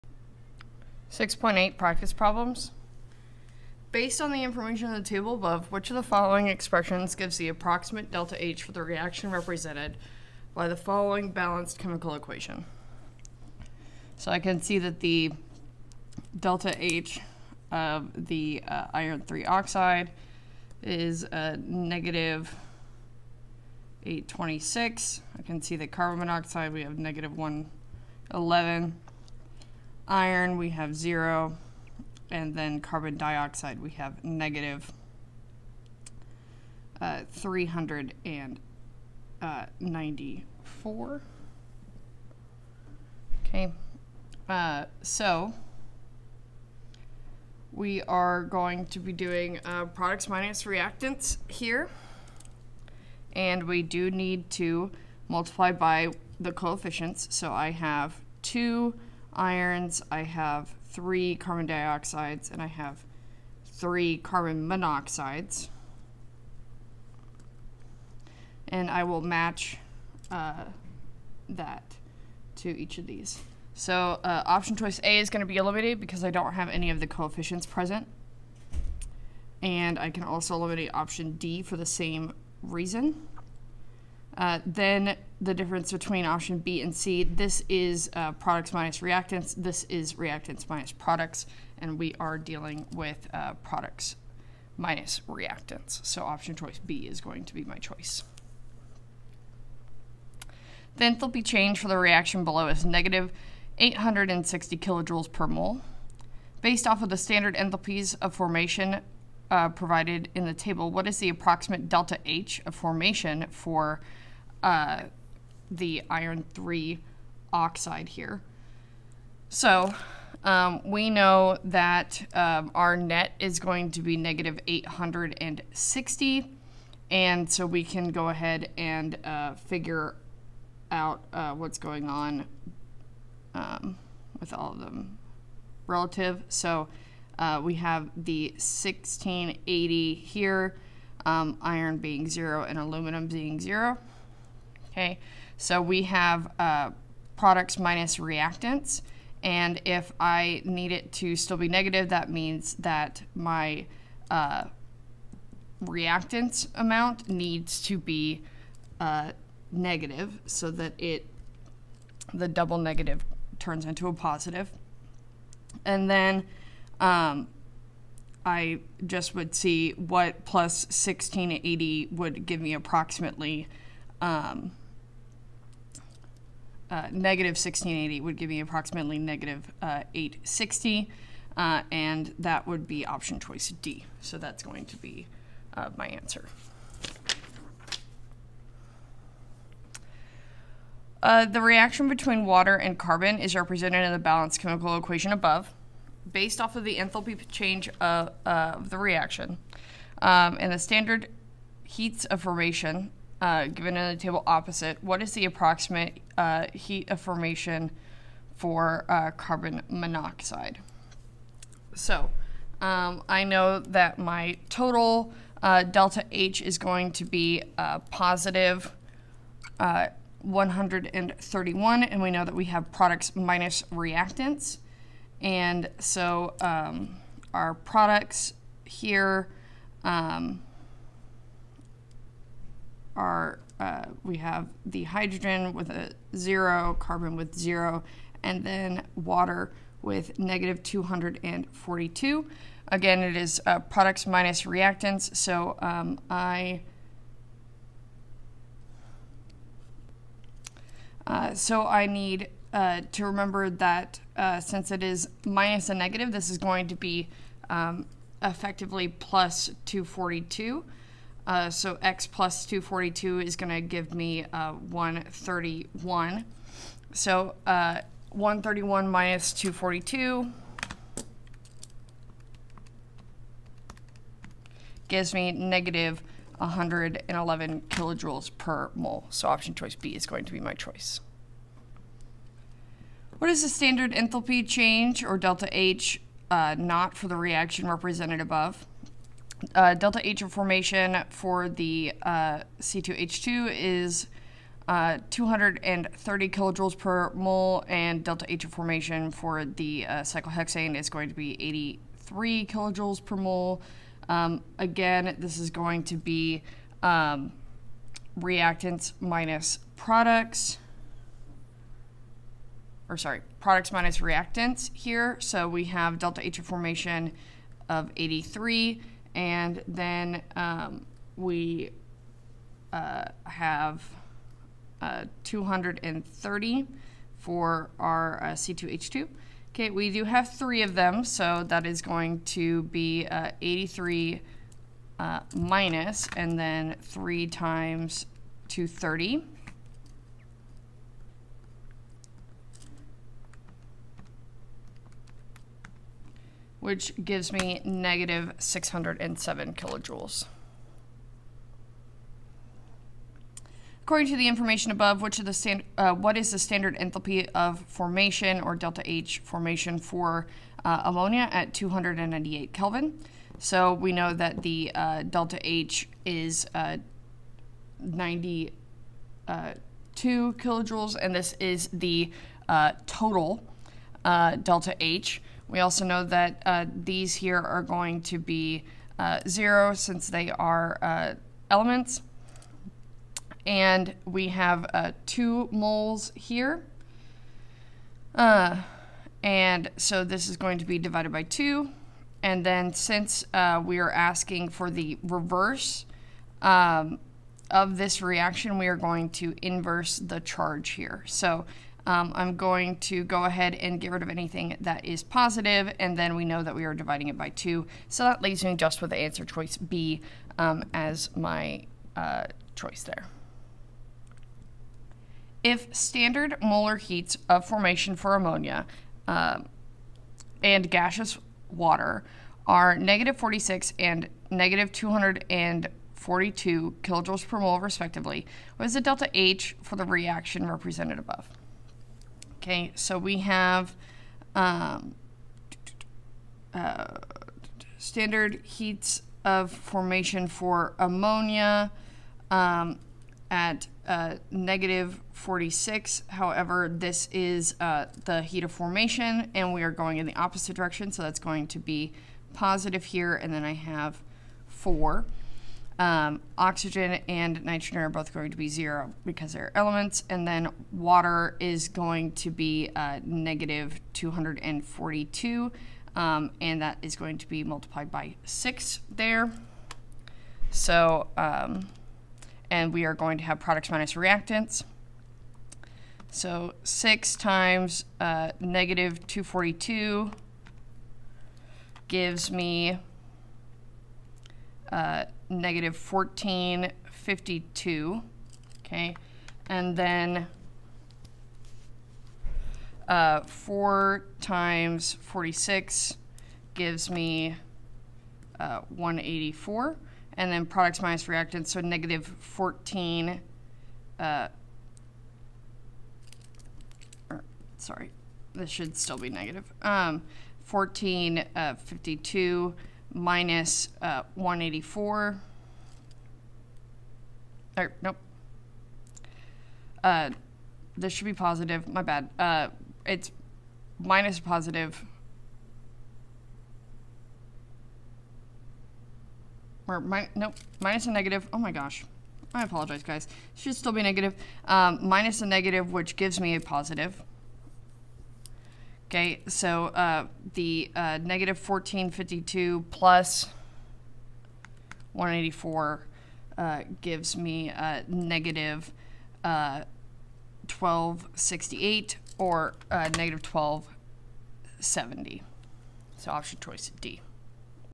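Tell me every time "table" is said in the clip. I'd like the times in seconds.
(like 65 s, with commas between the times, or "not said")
5 s, 110 s, 204 s.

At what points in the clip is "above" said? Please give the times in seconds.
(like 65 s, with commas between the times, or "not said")
5 s, 195 s, 288 s, 354 s, 431 s.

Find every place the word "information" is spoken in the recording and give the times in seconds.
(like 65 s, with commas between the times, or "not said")
4 s, 354 s.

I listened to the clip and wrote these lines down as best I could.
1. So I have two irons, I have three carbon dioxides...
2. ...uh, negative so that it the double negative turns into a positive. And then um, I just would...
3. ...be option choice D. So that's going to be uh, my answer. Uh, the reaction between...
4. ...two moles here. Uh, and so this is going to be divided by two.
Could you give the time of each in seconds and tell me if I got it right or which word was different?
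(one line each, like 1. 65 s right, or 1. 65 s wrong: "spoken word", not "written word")
1. 57 s right
2. 158 s right
3. 182 s right
4. 385 s right.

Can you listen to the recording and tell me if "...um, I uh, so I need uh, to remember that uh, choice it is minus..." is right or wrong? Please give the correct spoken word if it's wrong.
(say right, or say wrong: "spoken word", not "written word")
wrong: "since", not "choice".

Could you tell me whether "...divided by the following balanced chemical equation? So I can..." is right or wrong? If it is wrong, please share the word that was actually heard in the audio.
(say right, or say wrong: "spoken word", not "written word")
wrong: "represented", not "divided".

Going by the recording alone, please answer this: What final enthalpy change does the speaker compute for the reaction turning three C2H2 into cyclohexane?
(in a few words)
-607 kJ.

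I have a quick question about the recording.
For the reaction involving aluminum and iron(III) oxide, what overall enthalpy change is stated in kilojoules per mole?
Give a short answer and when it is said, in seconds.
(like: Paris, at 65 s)
-860 kJ/mol, at 102 s.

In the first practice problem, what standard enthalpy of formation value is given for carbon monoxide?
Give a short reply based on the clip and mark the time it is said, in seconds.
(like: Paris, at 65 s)
-111, at 25 s.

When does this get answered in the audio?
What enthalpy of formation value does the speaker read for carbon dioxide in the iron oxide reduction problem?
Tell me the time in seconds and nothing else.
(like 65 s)
34 s.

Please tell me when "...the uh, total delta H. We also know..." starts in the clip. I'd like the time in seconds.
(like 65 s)
371 s.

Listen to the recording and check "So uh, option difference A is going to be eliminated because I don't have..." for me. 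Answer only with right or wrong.
wrong.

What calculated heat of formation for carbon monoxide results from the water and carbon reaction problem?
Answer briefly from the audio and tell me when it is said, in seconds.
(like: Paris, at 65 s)
-111 kJ/mol, at 275 s.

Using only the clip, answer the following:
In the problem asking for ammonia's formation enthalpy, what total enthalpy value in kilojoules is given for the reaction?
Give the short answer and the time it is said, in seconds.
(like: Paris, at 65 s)
92 kJ, at 367 s.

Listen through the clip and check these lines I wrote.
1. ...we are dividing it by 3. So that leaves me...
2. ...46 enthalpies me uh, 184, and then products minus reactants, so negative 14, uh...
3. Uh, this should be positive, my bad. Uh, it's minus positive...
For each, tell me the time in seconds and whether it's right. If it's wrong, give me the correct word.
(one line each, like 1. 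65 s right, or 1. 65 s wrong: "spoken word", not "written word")
1. 406 s wrong: "2", not "3"
2. 495 s wrong: "gives", not "enthalpies"
3. 520 s right.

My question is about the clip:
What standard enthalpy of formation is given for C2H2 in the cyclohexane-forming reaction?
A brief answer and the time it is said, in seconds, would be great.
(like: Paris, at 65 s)
230 kJ/mol, at 295 s.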